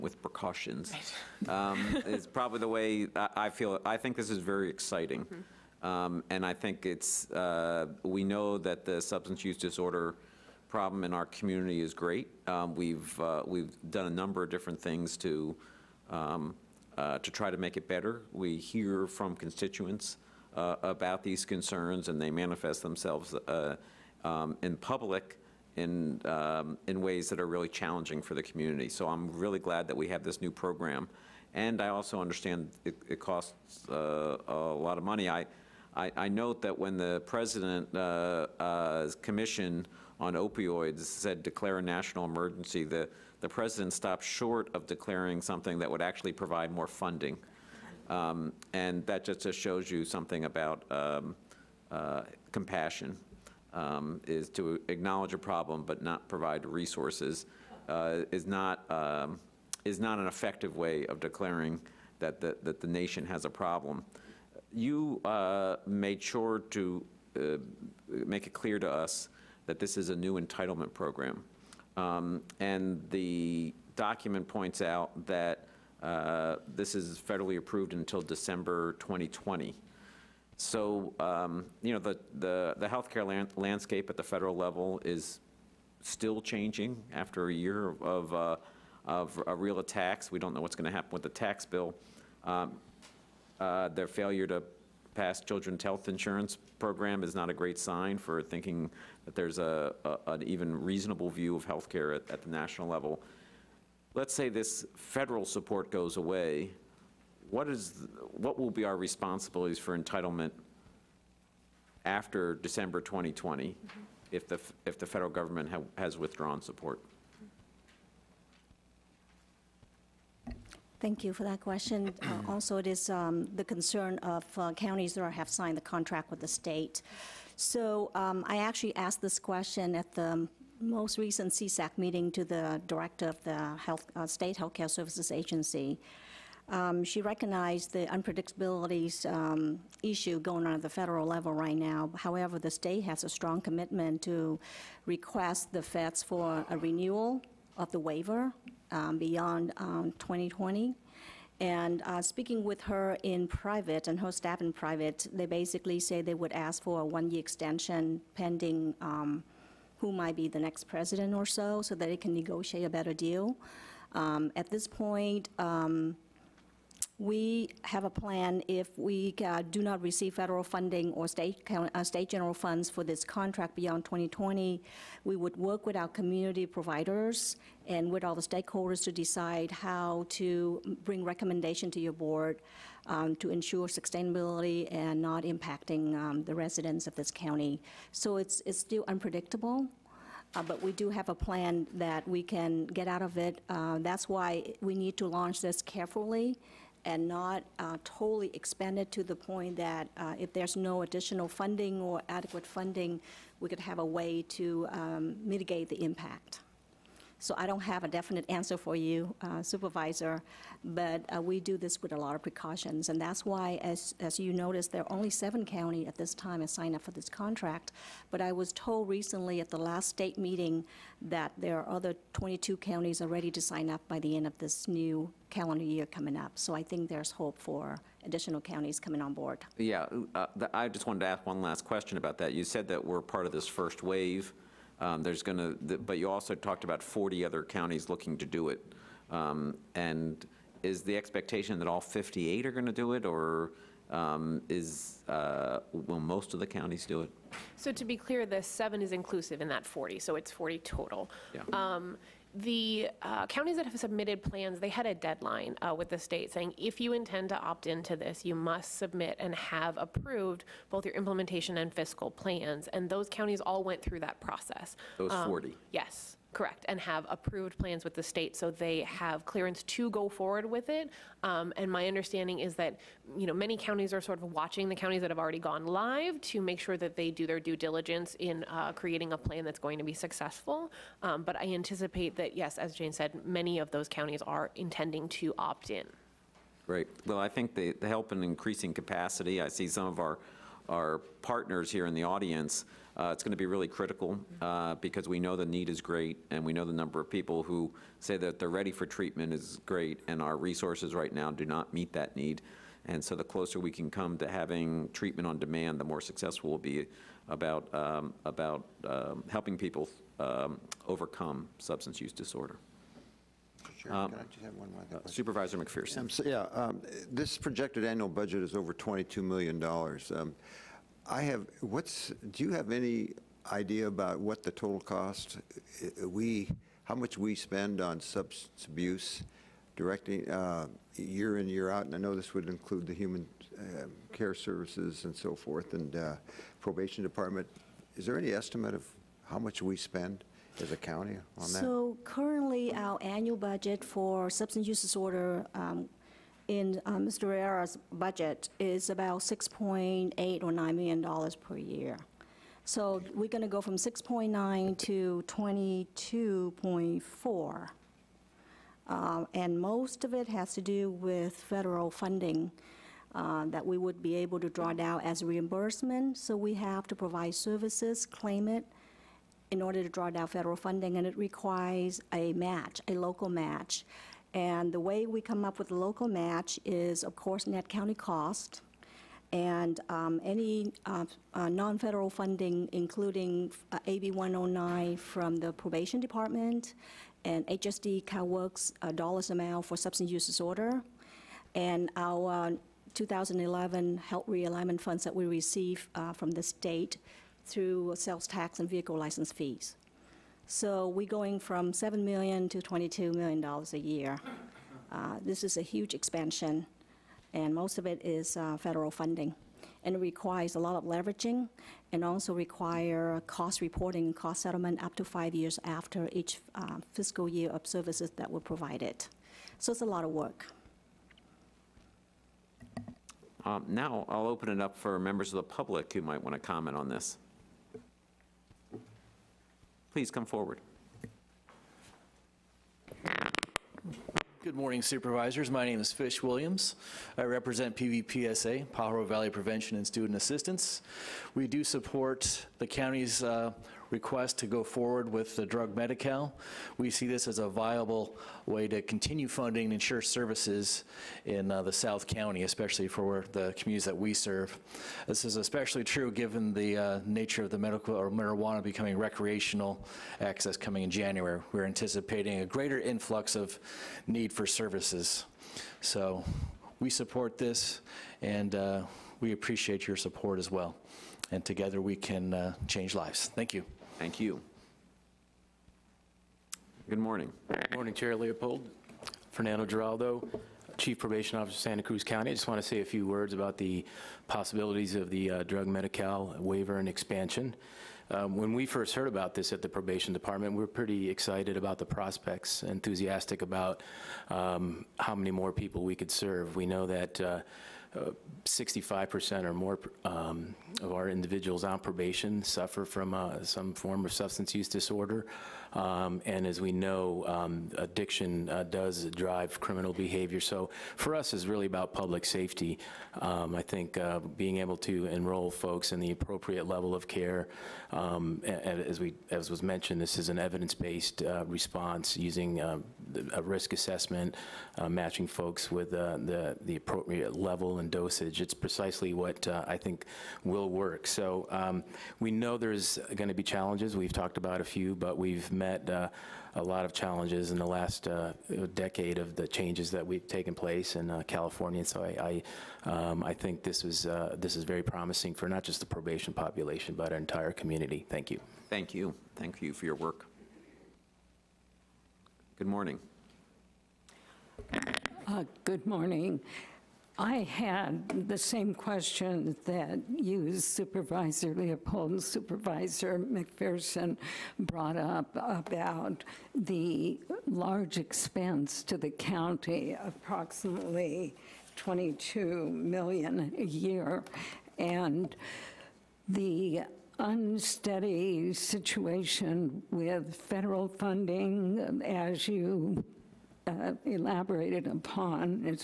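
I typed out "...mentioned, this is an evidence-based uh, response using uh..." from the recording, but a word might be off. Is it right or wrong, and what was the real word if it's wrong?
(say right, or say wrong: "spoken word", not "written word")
right.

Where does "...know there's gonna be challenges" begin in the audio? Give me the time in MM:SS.
08:52.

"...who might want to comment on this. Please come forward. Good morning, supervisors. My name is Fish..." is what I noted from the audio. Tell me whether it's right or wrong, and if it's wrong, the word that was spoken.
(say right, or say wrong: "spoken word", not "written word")
right.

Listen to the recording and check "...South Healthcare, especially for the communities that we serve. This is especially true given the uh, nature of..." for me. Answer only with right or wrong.
wrong.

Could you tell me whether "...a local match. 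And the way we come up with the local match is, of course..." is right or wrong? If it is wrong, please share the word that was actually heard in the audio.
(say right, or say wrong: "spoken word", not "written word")
right.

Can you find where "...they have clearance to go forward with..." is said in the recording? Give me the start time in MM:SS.
04:28.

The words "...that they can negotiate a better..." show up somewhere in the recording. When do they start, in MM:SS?
02:41.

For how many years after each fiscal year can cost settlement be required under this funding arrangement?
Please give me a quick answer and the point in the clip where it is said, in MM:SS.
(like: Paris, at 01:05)
5 years, at 06:55.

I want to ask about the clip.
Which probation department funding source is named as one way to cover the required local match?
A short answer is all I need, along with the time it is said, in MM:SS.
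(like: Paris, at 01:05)
AB 109, at 06:24.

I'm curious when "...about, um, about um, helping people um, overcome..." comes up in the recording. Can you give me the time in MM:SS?
05:07.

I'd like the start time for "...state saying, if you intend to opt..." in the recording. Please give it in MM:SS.
04:16.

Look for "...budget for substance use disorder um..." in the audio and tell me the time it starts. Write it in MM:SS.
05:43.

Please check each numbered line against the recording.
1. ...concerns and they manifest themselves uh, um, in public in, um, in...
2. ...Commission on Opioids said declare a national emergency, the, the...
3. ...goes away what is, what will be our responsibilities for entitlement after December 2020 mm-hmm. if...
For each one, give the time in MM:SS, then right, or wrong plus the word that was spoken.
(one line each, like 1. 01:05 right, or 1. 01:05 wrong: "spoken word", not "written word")
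1. 00:21 right
2. 00:39 right
3. 01:45 right.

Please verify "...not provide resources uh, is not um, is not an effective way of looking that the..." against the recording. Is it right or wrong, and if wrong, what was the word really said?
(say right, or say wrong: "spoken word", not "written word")
wrong: "declaring", not "looking".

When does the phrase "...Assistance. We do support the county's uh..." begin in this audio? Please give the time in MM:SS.
07:20.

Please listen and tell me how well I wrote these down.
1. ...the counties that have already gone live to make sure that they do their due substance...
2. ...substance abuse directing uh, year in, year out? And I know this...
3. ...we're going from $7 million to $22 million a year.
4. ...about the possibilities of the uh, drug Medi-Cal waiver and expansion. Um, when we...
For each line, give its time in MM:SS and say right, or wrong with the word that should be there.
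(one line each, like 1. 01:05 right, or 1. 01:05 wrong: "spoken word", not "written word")
1. 04:34 wrong: "diligence", not "substance"
2. 05:28 right
3. 06:41 right
4. 08:03 right.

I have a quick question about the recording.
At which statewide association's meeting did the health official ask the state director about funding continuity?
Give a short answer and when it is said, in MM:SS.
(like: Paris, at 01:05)
CSAC, at 02:11.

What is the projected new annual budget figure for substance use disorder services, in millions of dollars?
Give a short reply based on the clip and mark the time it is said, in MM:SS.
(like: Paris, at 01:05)
22.4 million, at 05:55.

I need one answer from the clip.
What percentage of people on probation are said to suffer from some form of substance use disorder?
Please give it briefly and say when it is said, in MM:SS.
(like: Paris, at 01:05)
65%, at 08:18.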